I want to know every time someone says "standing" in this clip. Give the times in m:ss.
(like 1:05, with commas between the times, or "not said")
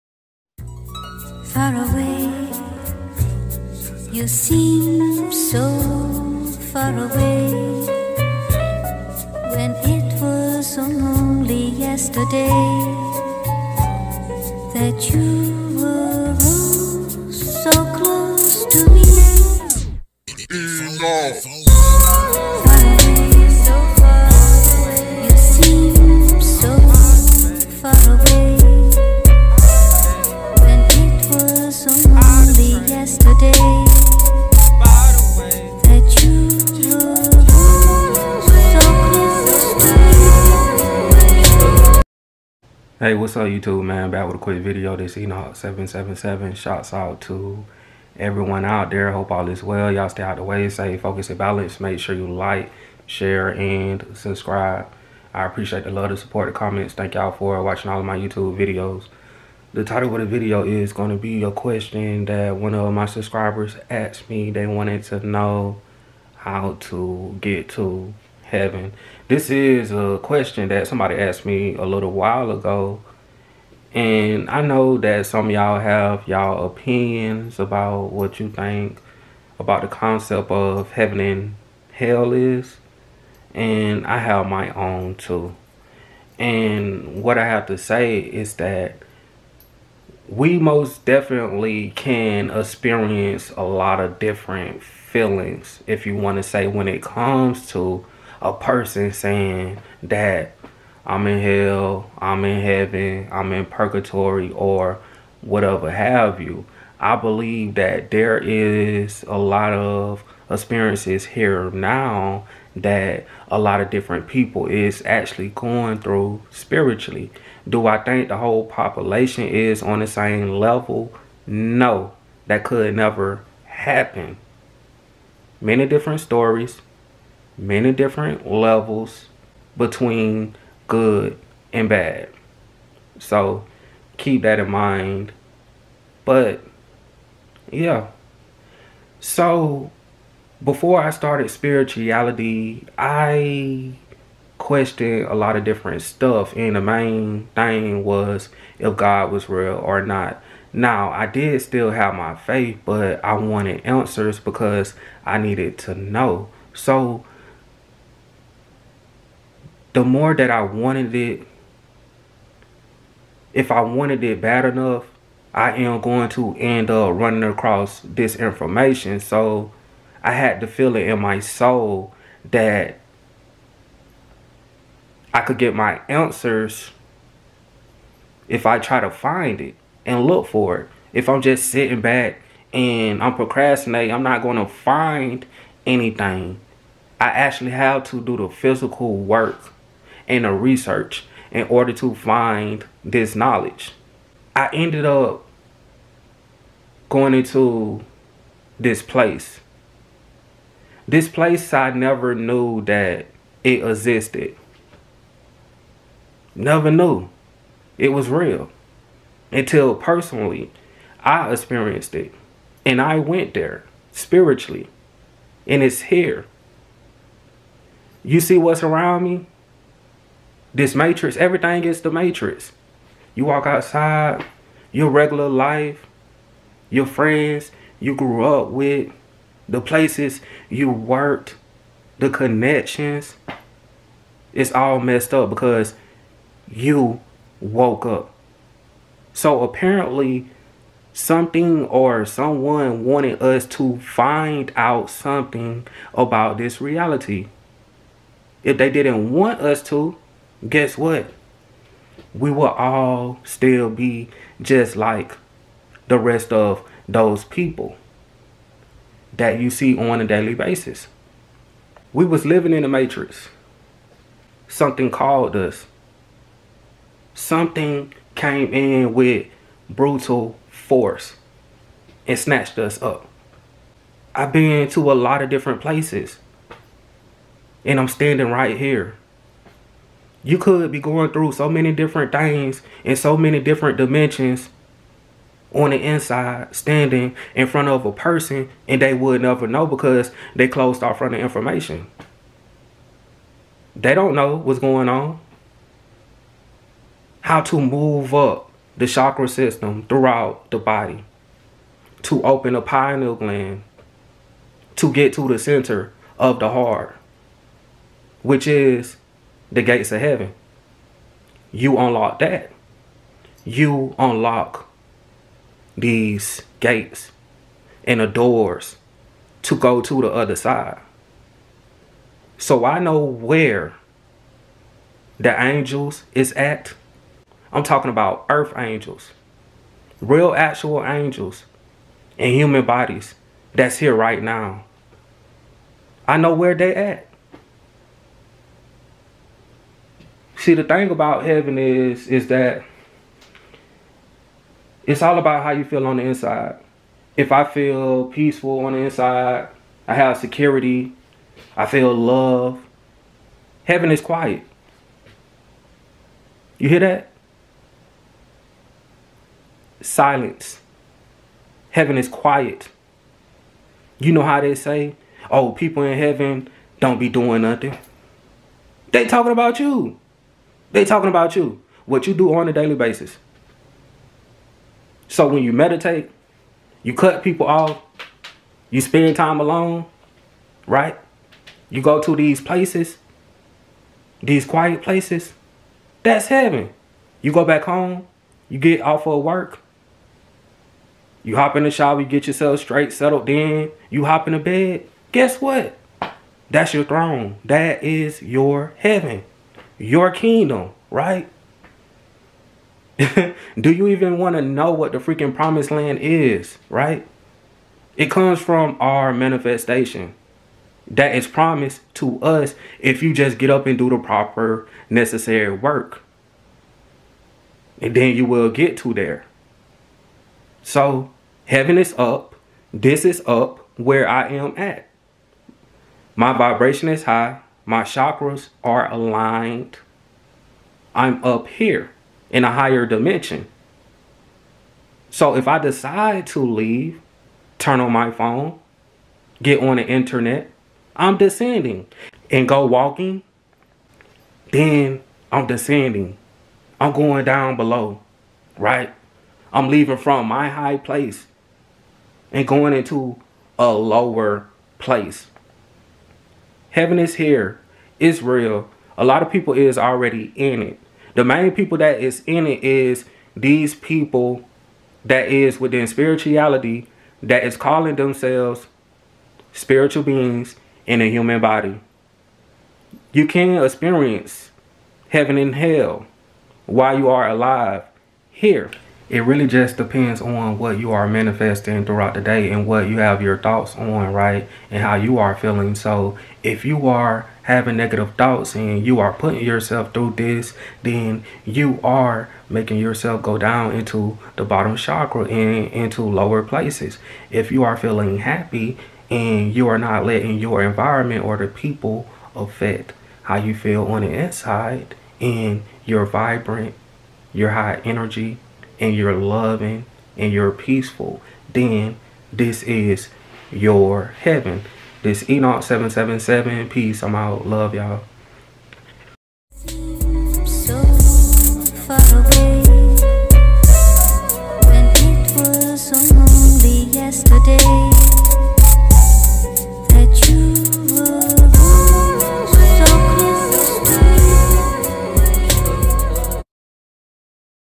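4:38, 4:46.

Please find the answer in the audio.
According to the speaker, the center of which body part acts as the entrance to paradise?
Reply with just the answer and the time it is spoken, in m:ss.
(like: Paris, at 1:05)
The heart, at 5:05.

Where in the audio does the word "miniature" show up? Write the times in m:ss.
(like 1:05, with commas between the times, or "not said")
not said.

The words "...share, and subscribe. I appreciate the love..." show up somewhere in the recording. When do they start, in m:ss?
0:53.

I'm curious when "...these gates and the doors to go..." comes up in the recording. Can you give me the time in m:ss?
5:15.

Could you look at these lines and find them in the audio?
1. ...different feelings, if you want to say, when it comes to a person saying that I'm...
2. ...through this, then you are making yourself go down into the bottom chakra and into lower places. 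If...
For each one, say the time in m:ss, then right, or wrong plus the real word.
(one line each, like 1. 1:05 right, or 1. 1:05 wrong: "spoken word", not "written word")
1. 1:34 right
2. 8:10 right.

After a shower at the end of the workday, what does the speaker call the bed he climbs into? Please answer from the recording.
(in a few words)
Throne.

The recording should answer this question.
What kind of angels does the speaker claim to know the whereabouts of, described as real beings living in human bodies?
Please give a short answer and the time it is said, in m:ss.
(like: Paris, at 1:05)
Earth angels, at 5:28.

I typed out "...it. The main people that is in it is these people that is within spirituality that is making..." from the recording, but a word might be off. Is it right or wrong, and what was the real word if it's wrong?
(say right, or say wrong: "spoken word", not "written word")
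wrong: "calling", not "making".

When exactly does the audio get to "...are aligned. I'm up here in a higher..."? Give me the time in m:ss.
7:08.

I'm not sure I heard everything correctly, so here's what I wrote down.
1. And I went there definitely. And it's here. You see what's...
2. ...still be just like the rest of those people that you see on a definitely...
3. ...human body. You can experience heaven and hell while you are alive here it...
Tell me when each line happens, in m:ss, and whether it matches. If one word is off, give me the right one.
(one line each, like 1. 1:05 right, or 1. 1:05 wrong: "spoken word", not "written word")
1. 3:32 wrong: "spiritually", not "definitely"
2. 4:13 wrong: "daily", not "definitely"
3. 7:51 right.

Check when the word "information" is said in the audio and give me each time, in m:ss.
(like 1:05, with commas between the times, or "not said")
2:48, 4:51.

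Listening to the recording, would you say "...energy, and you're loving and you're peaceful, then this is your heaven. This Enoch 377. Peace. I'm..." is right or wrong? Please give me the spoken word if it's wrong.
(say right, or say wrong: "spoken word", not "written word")
wrong: "777", not "377".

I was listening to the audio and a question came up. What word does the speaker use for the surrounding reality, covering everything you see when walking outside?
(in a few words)
The matrix.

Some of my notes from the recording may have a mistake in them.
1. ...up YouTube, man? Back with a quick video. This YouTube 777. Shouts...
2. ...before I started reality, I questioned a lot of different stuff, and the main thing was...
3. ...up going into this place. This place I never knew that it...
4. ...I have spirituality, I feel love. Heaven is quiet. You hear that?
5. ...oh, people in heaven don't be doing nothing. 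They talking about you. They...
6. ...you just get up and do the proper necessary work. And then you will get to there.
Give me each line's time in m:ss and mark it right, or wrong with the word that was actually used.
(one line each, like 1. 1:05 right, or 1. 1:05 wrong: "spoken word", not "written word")
1. 0:43 wrong: "Enoch", not "YouTube"
2. 2:20 wrong: "spirituality", not "reality"
3. 3:15 right
4. 5:50 wrong: "security", not "spirituality"
5. 6:05 right
6. 6:53 right.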